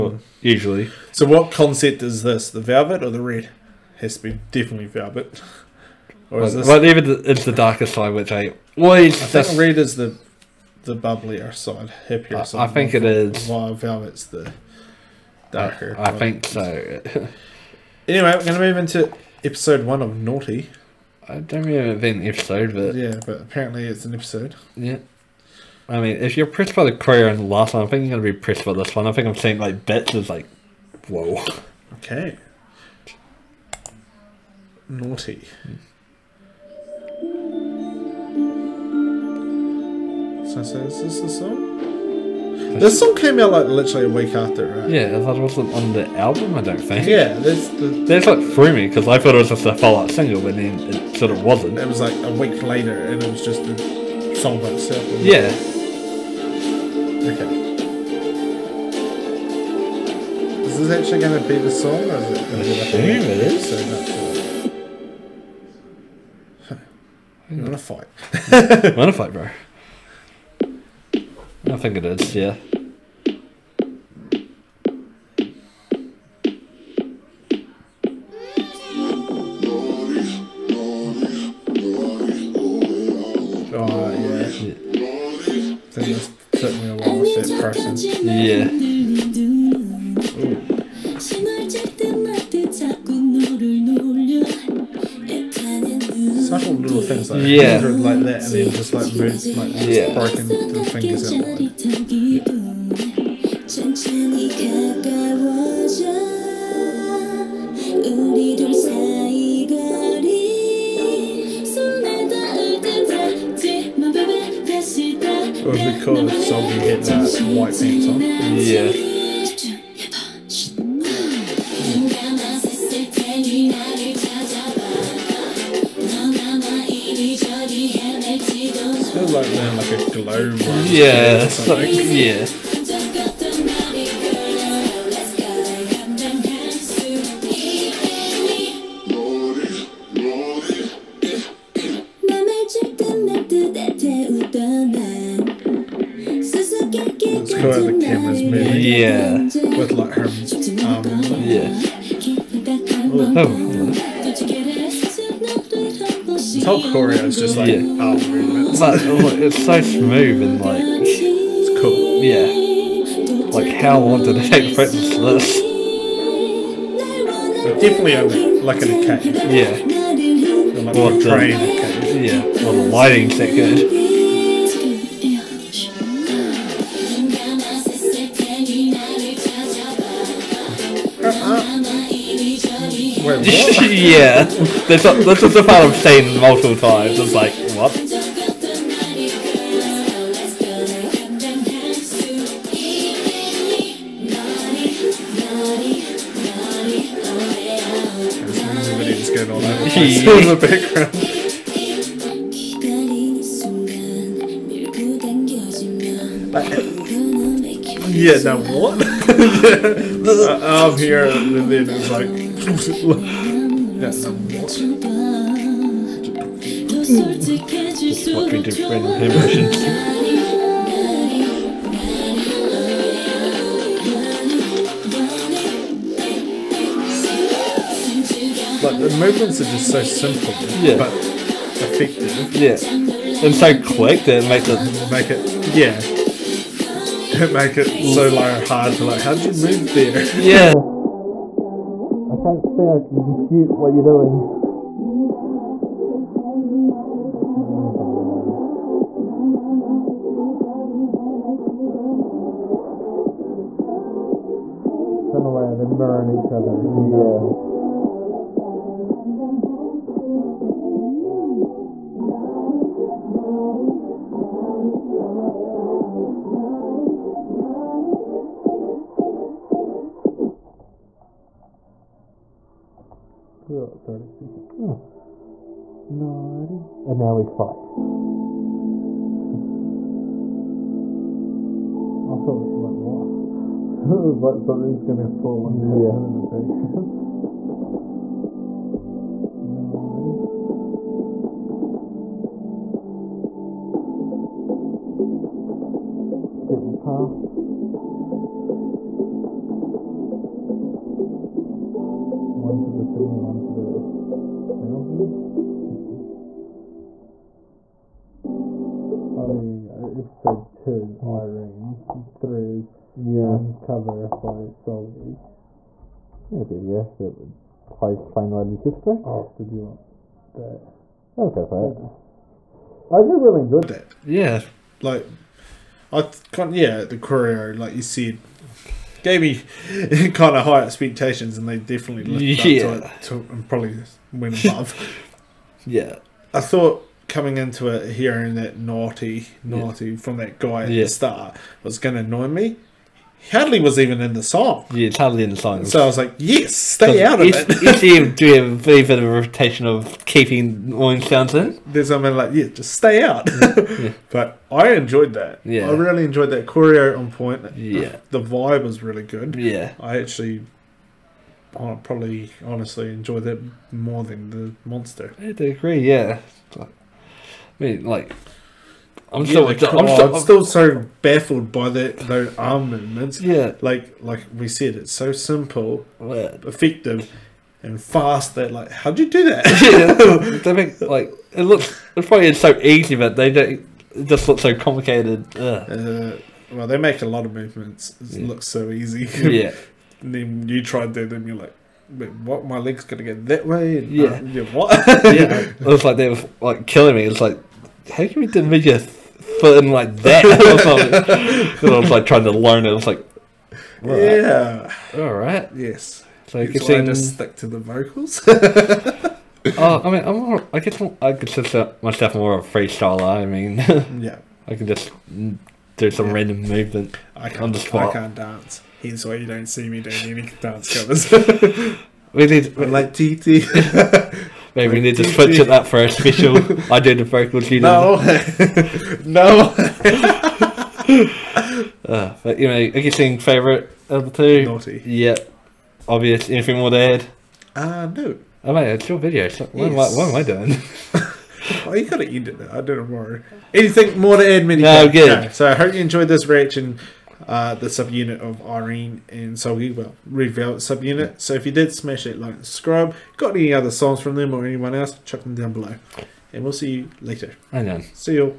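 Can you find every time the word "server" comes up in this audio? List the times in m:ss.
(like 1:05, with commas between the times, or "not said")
not said.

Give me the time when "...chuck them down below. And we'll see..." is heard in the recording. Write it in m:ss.
7:35.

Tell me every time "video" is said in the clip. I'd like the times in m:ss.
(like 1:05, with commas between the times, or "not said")
6:38, 7:19.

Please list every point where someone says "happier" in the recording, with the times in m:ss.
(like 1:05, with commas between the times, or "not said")
0:12.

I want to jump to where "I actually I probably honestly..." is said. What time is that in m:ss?
6:00.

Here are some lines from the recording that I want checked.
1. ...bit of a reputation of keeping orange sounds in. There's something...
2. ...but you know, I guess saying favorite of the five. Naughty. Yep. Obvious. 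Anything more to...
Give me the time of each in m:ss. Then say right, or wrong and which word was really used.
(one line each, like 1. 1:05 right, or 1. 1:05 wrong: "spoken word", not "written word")
1. 5:49 right
2. 7:12 wrong: "two", not "five".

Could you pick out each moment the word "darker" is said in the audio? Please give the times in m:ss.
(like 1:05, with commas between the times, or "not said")
0:07, 0:15.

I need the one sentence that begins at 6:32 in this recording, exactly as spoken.
My leg's gonna go that way.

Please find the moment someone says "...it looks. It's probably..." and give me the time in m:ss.
6:21.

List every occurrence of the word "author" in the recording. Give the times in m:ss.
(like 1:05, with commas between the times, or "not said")
not said.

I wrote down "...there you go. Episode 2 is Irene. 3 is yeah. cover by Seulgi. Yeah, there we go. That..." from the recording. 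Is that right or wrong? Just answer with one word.
right.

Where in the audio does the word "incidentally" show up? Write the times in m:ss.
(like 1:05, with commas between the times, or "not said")
not said.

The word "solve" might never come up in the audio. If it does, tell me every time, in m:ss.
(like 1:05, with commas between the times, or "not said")
not said.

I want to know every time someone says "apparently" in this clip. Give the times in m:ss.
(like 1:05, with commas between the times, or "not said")
0:23.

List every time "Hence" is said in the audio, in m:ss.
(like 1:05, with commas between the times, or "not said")
6:59.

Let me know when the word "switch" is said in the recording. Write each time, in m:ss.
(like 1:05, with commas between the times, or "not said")
7:05.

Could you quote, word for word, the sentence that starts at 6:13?
Yeah, like like we said, it's so simple, yeah.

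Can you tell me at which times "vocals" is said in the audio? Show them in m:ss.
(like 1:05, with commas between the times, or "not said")
6:47, 7:07.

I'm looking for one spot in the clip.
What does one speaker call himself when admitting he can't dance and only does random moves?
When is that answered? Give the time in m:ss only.
6:52.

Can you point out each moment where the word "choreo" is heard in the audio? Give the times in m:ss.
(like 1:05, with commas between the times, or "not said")
0:26, 2:36, 5:27, 5:56.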